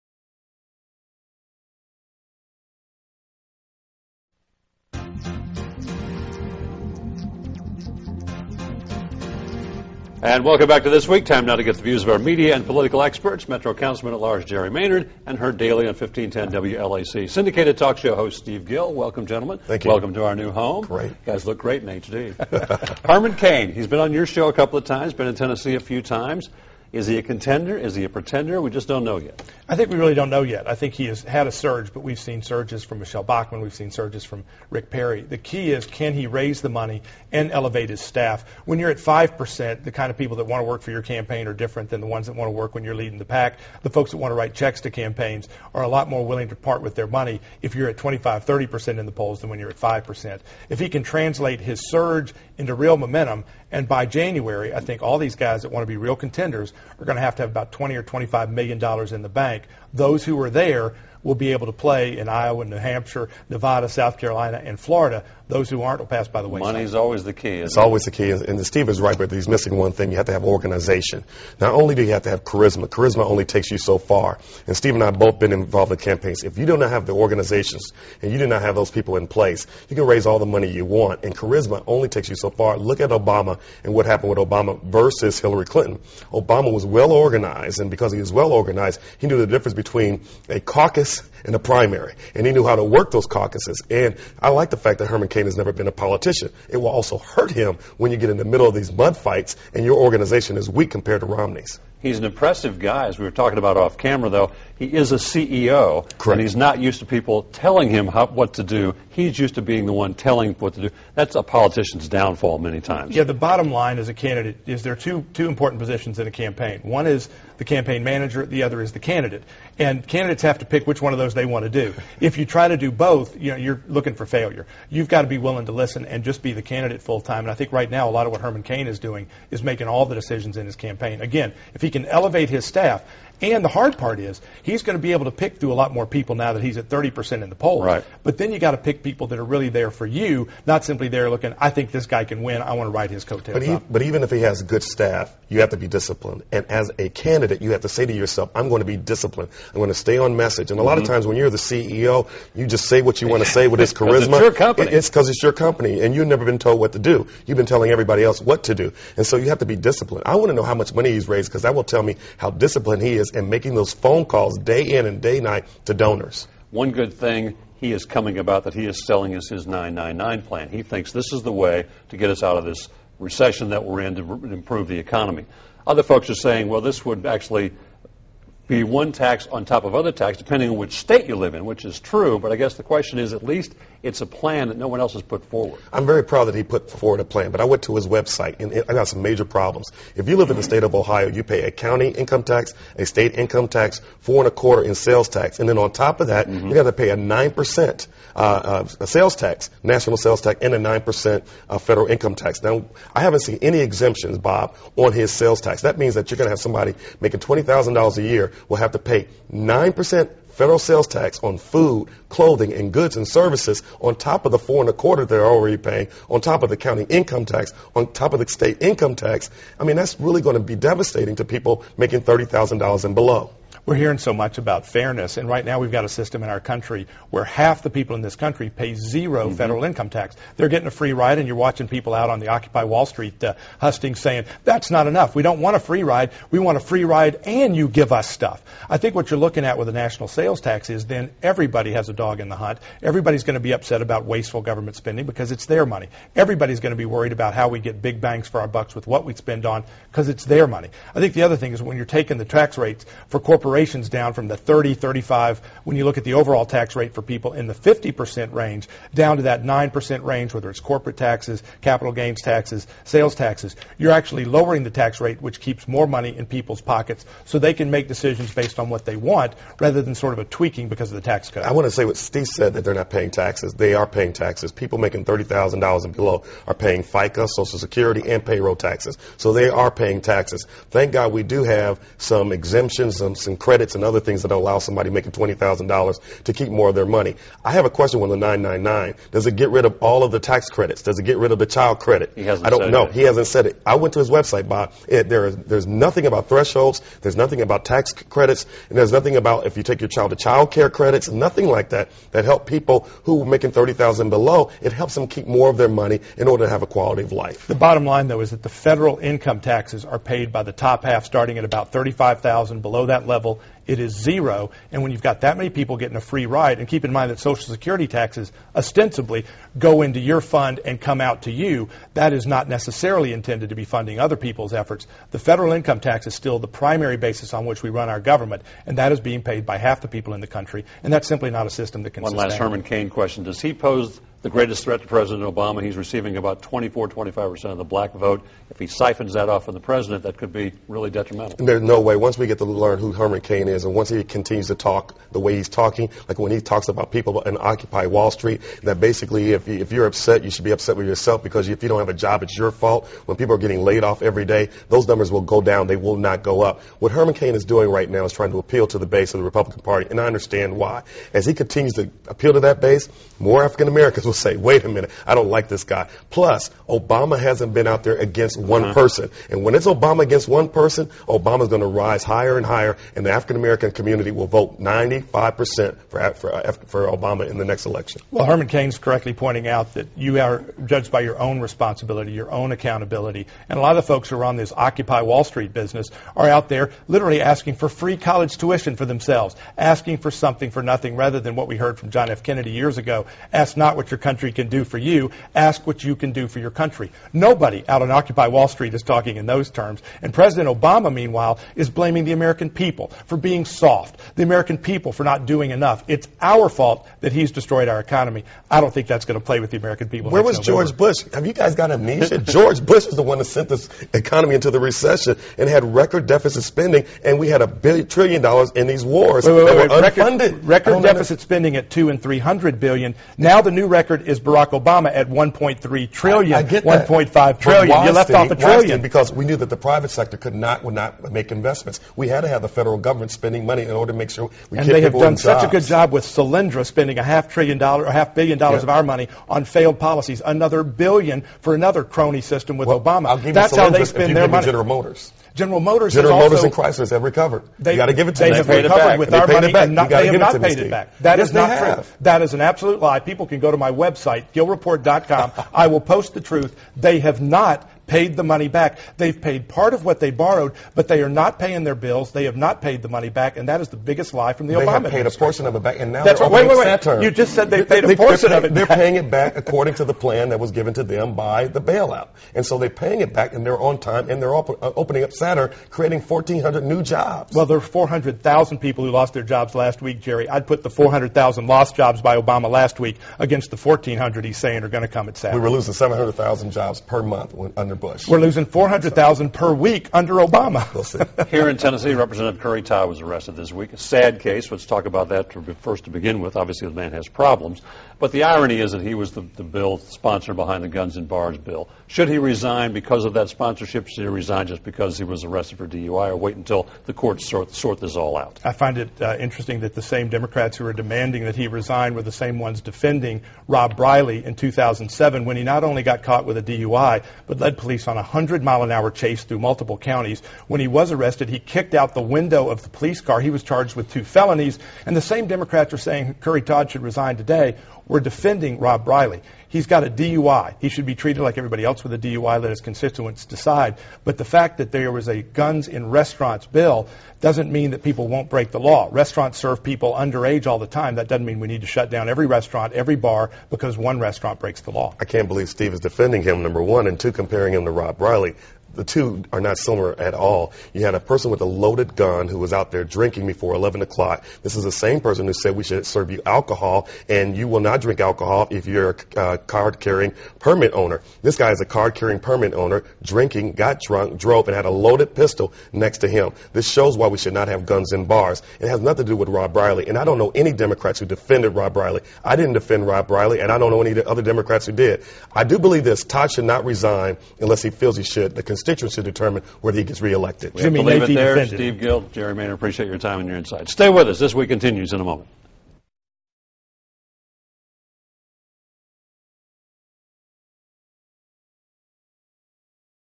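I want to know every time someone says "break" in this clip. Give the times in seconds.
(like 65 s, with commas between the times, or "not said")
538 s, 544 s.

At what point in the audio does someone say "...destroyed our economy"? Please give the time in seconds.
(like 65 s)
407 s.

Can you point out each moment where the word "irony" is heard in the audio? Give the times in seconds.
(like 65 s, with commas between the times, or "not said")
498 s.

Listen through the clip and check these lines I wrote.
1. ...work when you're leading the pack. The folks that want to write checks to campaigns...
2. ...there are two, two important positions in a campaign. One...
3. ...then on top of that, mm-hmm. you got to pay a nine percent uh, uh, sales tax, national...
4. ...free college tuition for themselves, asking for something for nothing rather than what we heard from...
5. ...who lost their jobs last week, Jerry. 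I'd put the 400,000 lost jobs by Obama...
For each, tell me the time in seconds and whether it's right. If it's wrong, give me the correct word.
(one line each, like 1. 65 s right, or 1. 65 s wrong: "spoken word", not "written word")
1. 42 s right
2. 114 s right
3. 195 s right
4. 387 s right
5. 479 s right.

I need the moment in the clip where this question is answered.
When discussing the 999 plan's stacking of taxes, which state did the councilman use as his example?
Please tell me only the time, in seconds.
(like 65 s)
190 s.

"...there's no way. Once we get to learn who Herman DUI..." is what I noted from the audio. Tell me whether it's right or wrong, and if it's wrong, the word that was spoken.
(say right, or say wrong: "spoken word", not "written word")
wrong: "Cain", not "DUI".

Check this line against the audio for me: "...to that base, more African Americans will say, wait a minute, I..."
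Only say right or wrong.
right.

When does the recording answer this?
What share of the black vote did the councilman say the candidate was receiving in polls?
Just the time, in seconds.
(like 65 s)
336 s.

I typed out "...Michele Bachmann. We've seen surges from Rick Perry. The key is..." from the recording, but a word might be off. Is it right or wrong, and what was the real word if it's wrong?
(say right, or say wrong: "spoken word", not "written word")
right.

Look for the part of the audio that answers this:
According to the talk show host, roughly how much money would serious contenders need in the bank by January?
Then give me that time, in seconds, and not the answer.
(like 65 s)
57 s.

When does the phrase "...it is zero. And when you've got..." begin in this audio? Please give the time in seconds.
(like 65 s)
313 s.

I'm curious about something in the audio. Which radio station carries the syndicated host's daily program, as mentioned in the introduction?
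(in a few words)
1510 WLAC.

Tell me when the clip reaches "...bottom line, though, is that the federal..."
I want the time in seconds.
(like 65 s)
307 s.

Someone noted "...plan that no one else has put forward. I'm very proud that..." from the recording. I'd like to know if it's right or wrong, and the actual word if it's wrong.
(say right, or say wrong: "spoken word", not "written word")
right.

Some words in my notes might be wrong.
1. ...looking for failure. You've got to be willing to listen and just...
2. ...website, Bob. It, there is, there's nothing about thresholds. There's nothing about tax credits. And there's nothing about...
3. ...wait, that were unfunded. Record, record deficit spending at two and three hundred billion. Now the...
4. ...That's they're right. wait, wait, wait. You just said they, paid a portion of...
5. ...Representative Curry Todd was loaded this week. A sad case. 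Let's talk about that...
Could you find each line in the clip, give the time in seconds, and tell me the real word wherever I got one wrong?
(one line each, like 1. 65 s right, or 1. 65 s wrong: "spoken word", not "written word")
1. 123 s right
2. 294 s right
3. 419 s right
4. 466 s right
5. 492 s wrong: "arrested", not "loaded".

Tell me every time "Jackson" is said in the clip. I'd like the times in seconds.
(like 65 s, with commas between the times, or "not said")
not said.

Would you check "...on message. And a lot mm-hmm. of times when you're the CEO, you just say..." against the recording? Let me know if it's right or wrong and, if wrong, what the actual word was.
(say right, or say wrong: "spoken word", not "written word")
right.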